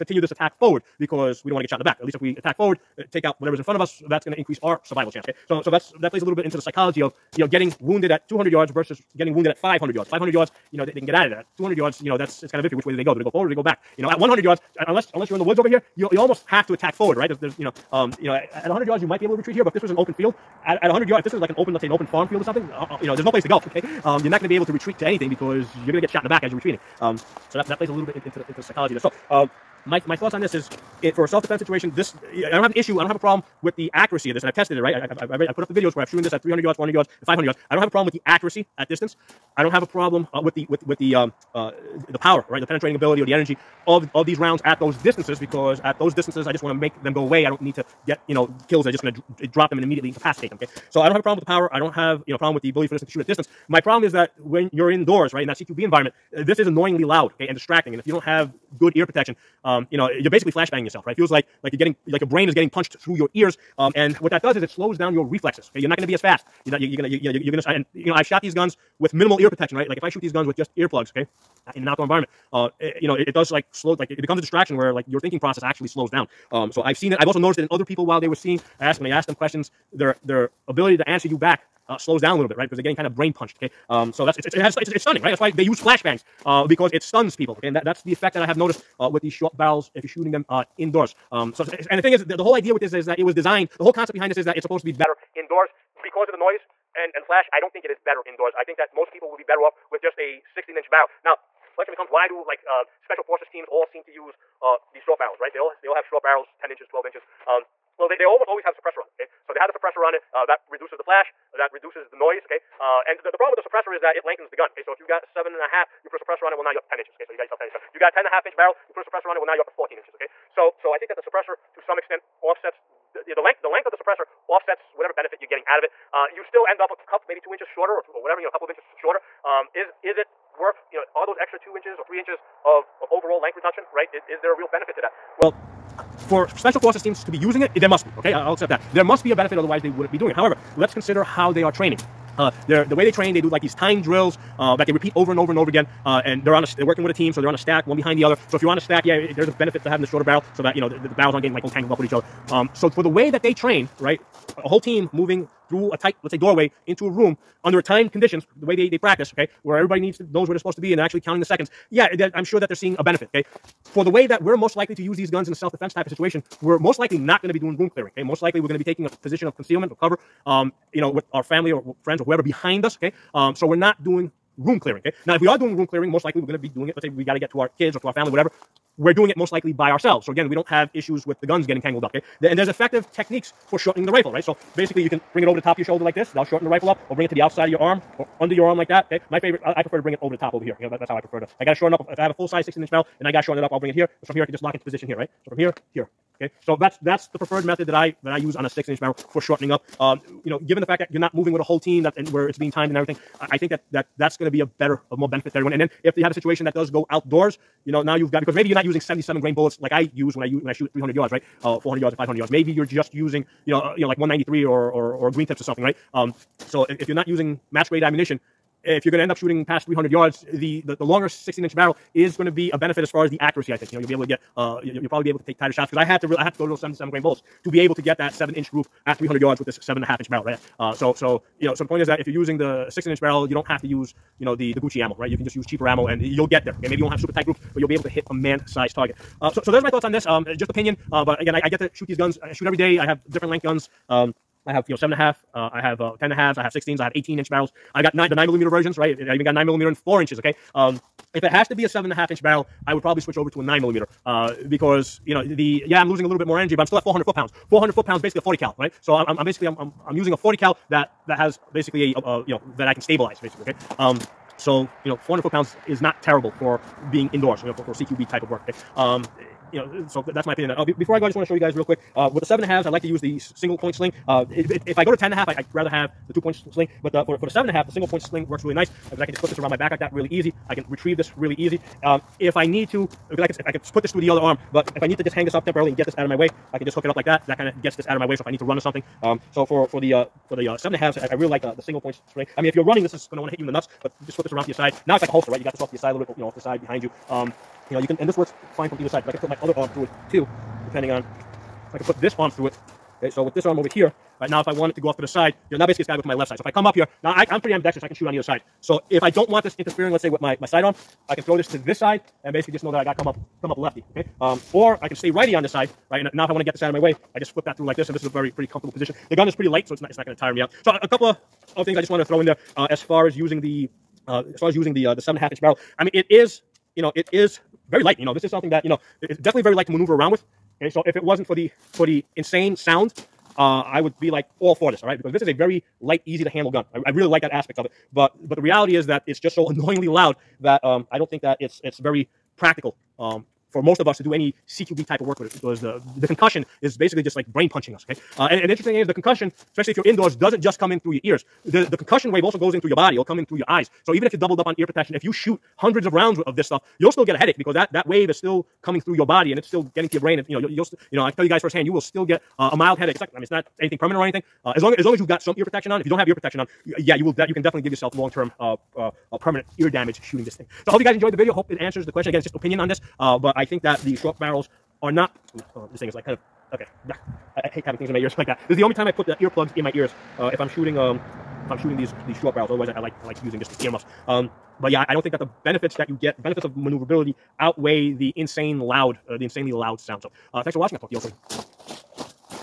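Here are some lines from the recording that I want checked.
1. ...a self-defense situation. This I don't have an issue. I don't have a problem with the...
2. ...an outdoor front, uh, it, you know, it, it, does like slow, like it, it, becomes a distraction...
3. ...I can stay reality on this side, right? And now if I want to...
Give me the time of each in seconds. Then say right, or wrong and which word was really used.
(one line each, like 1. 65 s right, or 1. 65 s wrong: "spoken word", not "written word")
1. 31 s right
2. 71 s wrong: "environment", not "front"
3. 315 s wrong: "righty", not "reality".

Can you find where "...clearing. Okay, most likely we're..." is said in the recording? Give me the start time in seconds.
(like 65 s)
167 s.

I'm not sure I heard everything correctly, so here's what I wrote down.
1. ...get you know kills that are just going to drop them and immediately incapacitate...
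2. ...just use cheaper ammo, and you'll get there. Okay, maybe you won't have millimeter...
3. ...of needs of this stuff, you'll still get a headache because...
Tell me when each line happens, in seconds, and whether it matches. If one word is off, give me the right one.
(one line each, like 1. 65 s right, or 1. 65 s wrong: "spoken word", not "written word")
1. 48 s right
2. 235 s wrong: "super", not "millimeter"
3. 356 s wrong: "rounds", not "needs".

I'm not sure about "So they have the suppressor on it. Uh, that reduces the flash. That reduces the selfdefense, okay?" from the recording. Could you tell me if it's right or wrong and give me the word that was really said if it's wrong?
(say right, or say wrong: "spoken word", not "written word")
wrong: "noise", not "selfdefense".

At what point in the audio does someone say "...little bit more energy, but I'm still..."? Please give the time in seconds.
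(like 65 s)
256 s.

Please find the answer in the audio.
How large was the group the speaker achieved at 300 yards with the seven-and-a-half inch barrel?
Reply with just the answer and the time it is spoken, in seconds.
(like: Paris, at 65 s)
7 inch, at 228 s.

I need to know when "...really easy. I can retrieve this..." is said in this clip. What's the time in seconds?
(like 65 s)
280 s.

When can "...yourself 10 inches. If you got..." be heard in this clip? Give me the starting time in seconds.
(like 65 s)
117 s.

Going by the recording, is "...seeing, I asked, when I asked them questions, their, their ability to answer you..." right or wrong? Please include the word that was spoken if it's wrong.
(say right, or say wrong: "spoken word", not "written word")
right.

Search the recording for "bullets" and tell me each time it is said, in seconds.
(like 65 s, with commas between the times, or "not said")
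209 s, 227 s.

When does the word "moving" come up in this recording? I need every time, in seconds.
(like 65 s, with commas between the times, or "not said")
155 s, 201 s.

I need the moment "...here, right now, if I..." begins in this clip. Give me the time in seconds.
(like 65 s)
303 s.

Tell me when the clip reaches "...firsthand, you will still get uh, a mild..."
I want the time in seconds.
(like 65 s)
361 s.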